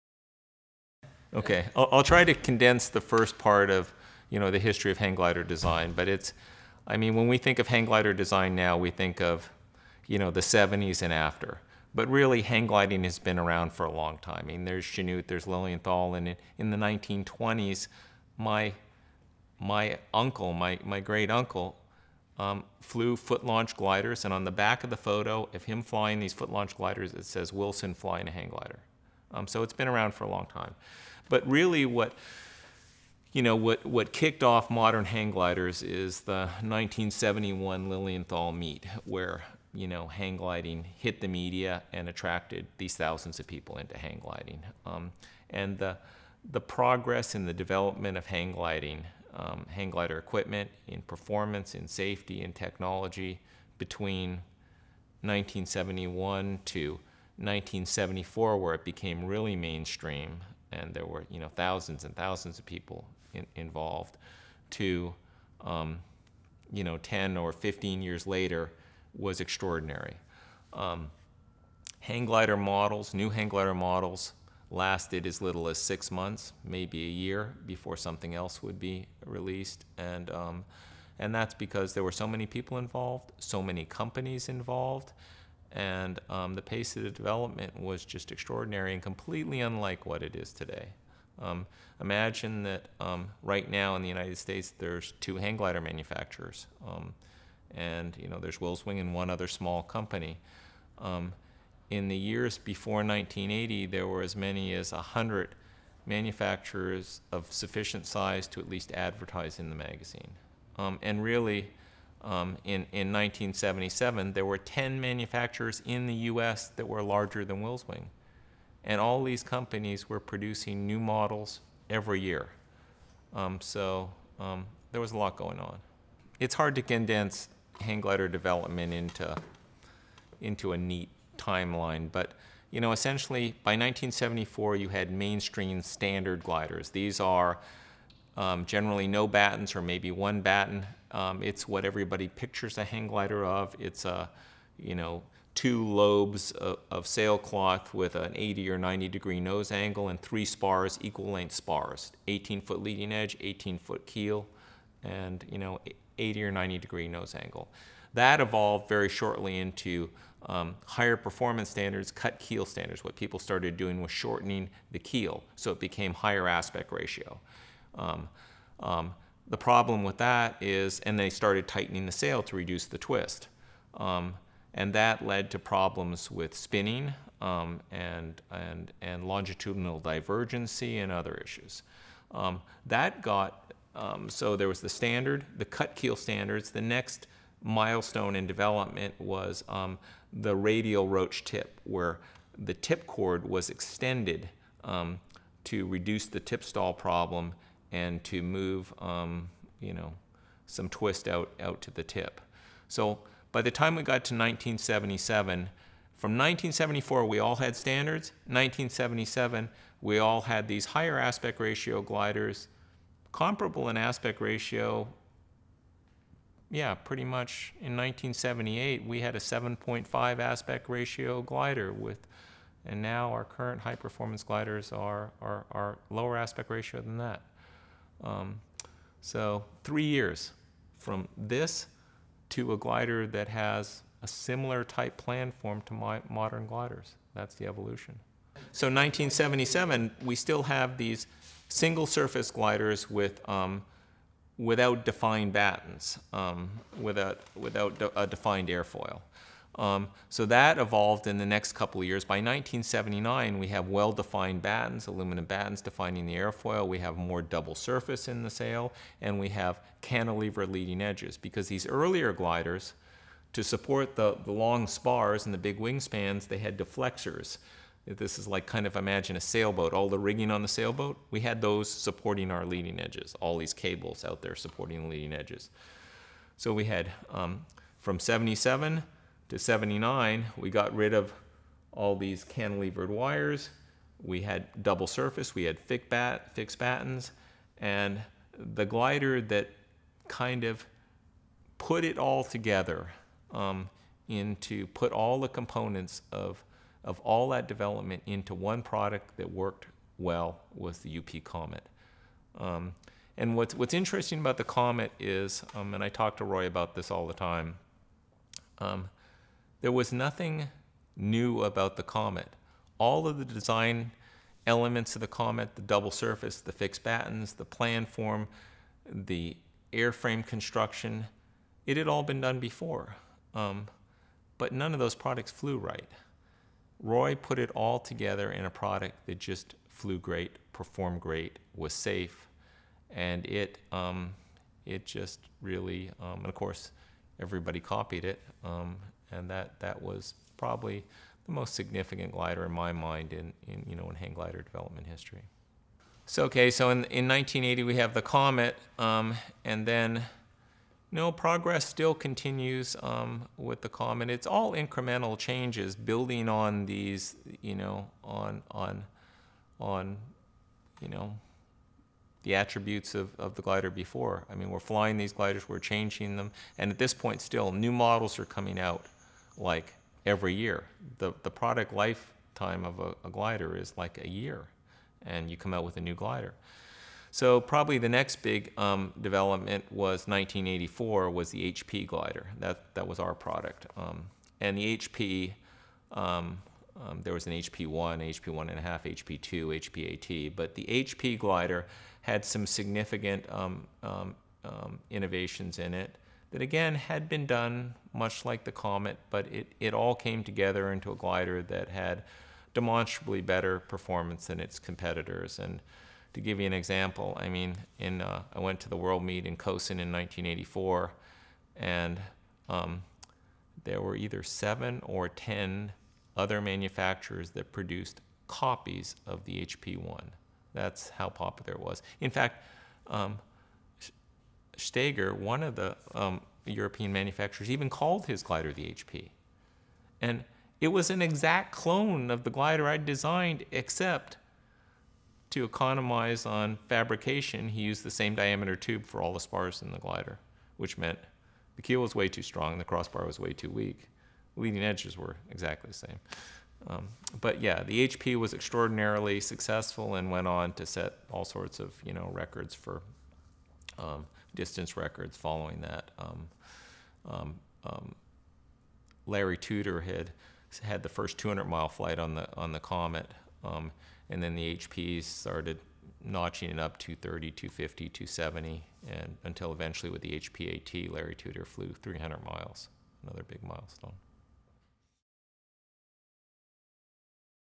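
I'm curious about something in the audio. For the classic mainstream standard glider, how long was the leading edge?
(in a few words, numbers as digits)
18 foot.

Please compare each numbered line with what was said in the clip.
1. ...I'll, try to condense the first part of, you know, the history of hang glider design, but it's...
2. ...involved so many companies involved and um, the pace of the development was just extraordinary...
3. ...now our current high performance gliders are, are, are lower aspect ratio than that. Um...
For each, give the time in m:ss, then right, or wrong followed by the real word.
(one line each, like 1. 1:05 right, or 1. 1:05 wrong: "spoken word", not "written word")
1. 0:01 right
2. 1:22 right
3. 3:43 right.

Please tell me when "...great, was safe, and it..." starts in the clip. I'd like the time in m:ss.
5:31.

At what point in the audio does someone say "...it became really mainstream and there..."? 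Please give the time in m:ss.
0:58.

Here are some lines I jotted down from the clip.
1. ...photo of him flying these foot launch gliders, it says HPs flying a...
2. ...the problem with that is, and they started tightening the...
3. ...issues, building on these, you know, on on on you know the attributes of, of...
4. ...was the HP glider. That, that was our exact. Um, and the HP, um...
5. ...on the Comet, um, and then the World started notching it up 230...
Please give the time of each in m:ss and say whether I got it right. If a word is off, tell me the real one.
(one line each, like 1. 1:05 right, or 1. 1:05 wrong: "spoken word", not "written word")
1. 0:24 wrong: "Wilson", not "HPs"
2. 2:49 right
3. 5:55 wrong: "changes", not "issues"
4. 6:21 wrong: "product", not "exact"
5. 7:42 wrong: "HPs", not "World".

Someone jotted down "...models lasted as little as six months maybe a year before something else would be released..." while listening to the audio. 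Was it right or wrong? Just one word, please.
right.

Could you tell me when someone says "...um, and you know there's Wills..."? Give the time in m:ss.
1:36.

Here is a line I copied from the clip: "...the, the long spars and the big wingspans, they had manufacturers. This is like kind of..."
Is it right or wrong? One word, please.
wrong.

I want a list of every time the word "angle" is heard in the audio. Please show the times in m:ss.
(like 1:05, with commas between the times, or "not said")
2:29, 2:37.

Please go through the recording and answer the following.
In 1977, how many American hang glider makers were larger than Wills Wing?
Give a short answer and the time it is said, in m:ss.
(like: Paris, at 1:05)
10, at 1:54.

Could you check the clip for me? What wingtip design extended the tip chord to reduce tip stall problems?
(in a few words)
radial roach tip.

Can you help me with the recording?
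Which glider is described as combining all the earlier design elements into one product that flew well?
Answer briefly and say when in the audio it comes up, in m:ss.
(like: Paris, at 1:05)
UP Comet, at 5:01.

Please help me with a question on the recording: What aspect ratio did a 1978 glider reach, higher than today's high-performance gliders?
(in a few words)
7.5.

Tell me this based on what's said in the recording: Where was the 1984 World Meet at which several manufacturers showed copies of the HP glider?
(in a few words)
Kössen.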